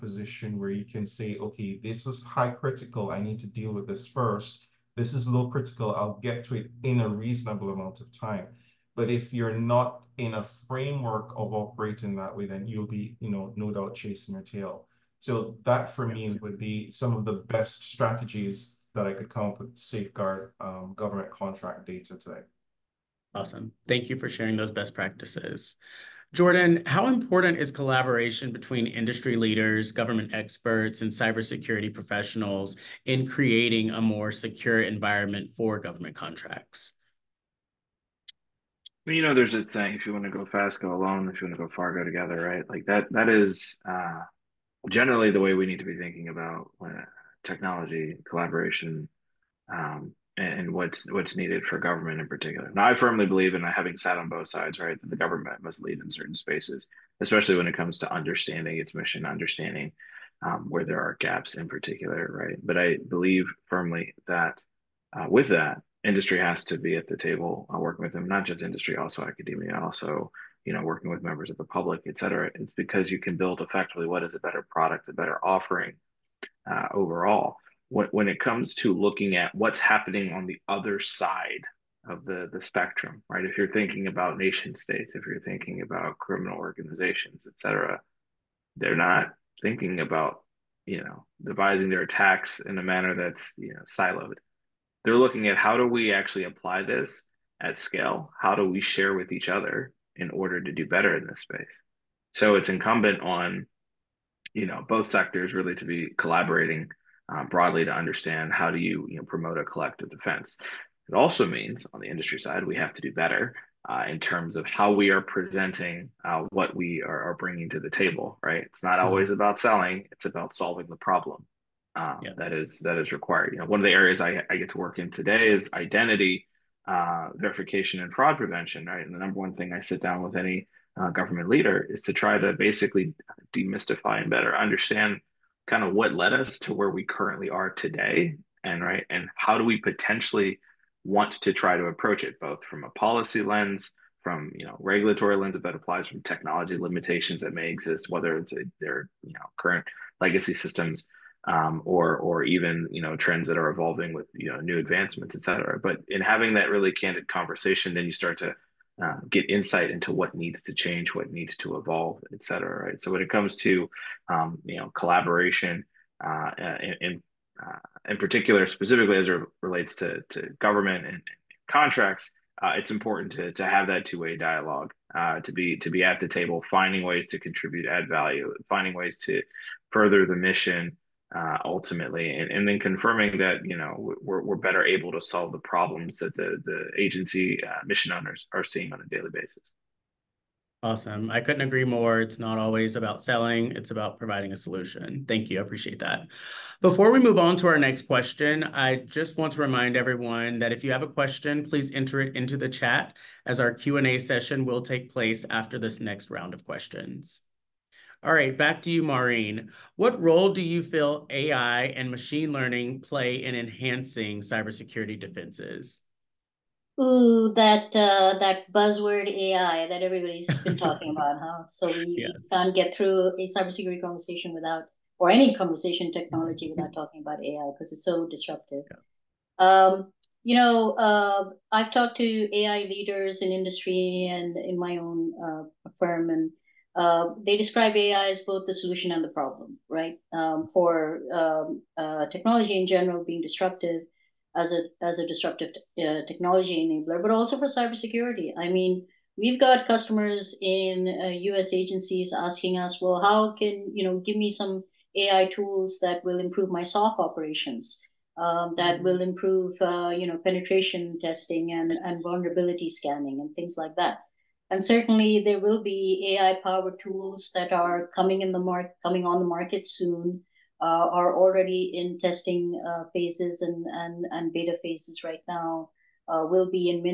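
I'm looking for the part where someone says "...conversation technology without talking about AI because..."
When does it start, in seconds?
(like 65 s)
225 s.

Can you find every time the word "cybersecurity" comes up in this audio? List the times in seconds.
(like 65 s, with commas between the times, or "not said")
31 s, 214 s, 223 s, 247 s.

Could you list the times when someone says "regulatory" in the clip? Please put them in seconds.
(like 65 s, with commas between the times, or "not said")
144 s.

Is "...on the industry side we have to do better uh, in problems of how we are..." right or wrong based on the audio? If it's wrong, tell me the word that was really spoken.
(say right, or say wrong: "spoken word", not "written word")
wrong: "terms", not "problems".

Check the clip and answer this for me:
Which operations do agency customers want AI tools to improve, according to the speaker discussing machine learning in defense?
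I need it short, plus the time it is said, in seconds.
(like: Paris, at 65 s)
SOC operations, at 256 s.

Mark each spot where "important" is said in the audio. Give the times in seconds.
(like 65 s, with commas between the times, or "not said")
27 s, 172 s.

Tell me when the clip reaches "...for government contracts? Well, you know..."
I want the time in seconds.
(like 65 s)
35 s.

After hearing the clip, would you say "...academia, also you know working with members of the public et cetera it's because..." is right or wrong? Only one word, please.
right.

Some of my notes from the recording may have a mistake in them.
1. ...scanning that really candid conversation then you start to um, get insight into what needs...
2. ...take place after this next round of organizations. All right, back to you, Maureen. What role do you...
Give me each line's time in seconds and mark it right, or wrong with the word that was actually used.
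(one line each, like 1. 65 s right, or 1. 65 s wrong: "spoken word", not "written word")
1. 156 s wrong: "having", not "scanning"
2. 204 s wrong: "questions", not "organizations".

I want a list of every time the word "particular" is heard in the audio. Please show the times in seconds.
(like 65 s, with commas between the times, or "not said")
52 s, 61 s, 168 s.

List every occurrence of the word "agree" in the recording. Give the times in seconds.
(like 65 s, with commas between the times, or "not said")
191 s.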